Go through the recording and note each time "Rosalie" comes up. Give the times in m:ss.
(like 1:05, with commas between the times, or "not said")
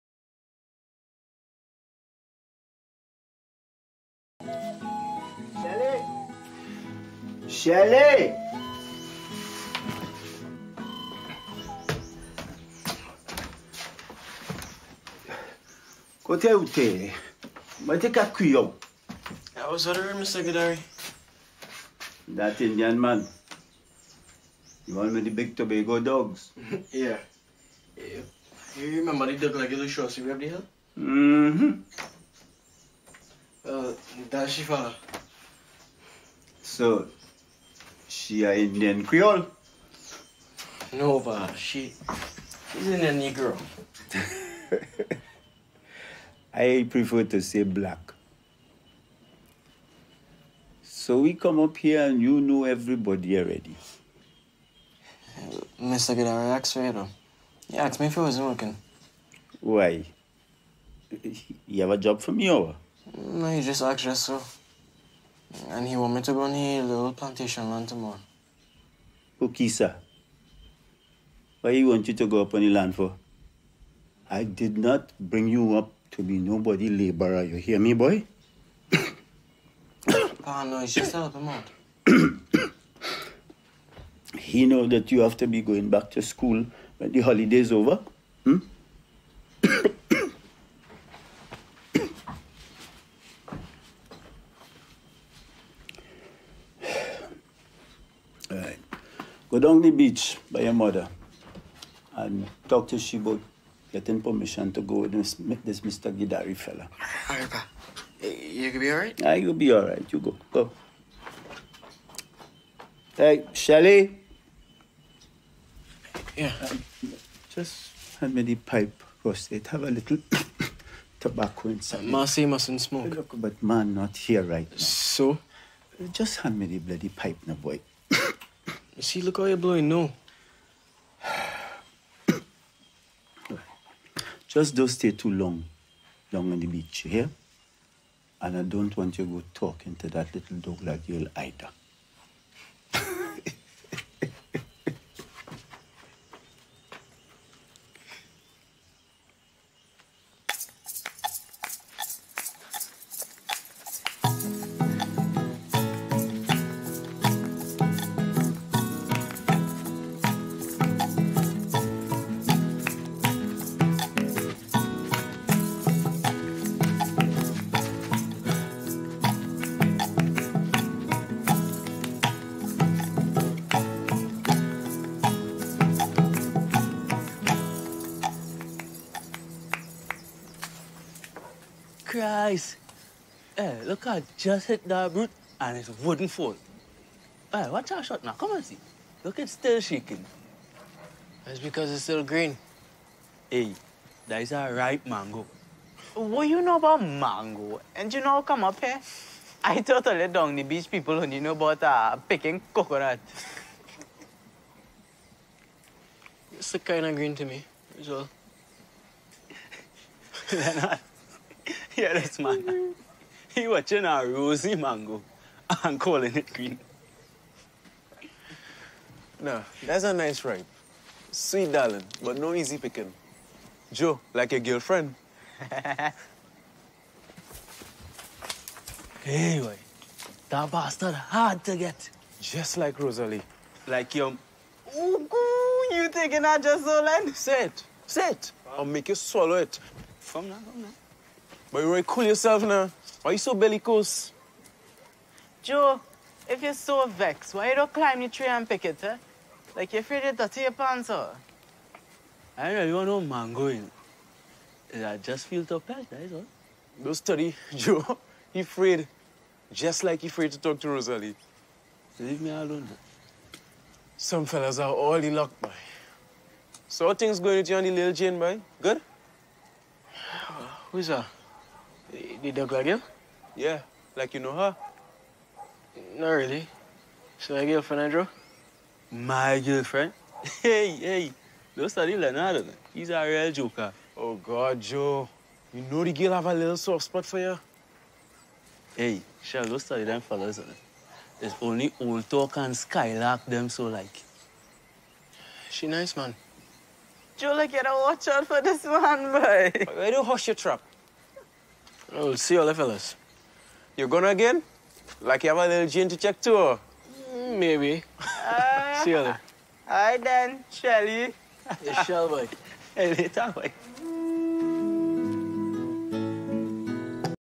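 3:52, 4:20.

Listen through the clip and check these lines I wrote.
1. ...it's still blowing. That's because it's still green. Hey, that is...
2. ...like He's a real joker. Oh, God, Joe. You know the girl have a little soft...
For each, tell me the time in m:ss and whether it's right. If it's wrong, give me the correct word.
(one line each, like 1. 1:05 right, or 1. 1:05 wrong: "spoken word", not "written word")
1. 3:09 wrong: "shaking", not "blowing"
2. 4:42 right.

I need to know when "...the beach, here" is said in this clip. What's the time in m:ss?
2:16.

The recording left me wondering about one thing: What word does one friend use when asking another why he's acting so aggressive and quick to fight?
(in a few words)
bellicose.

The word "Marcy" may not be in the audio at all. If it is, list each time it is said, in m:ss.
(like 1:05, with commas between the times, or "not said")
2:02.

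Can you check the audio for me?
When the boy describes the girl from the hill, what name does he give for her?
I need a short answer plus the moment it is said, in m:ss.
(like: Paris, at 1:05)
Shifara, at 0:34.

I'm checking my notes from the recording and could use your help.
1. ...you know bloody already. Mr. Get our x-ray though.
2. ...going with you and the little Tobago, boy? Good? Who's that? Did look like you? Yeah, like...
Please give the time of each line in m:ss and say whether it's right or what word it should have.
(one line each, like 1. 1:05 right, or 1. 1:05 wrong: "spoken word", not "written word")
1. 0:52 wrong: "everybody", not "bloody"
2. 4:27 wrong: "Jane", not "Tobago".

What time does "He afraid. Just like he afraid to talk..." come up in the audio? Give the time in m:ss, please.
4:18.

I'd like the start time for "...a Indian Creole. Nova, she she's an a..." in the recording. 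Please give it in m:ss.
0:38.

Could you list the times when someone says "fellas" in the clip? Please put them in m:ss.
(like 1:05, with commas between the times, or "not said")
1:46, 4:24, 4:50, 5:02.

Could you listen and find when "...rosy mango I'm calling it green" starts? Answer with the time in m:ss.
3:34.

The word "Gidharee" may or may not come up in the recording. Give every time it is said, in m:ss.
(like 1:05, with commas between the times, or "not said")
0:20, 1:46.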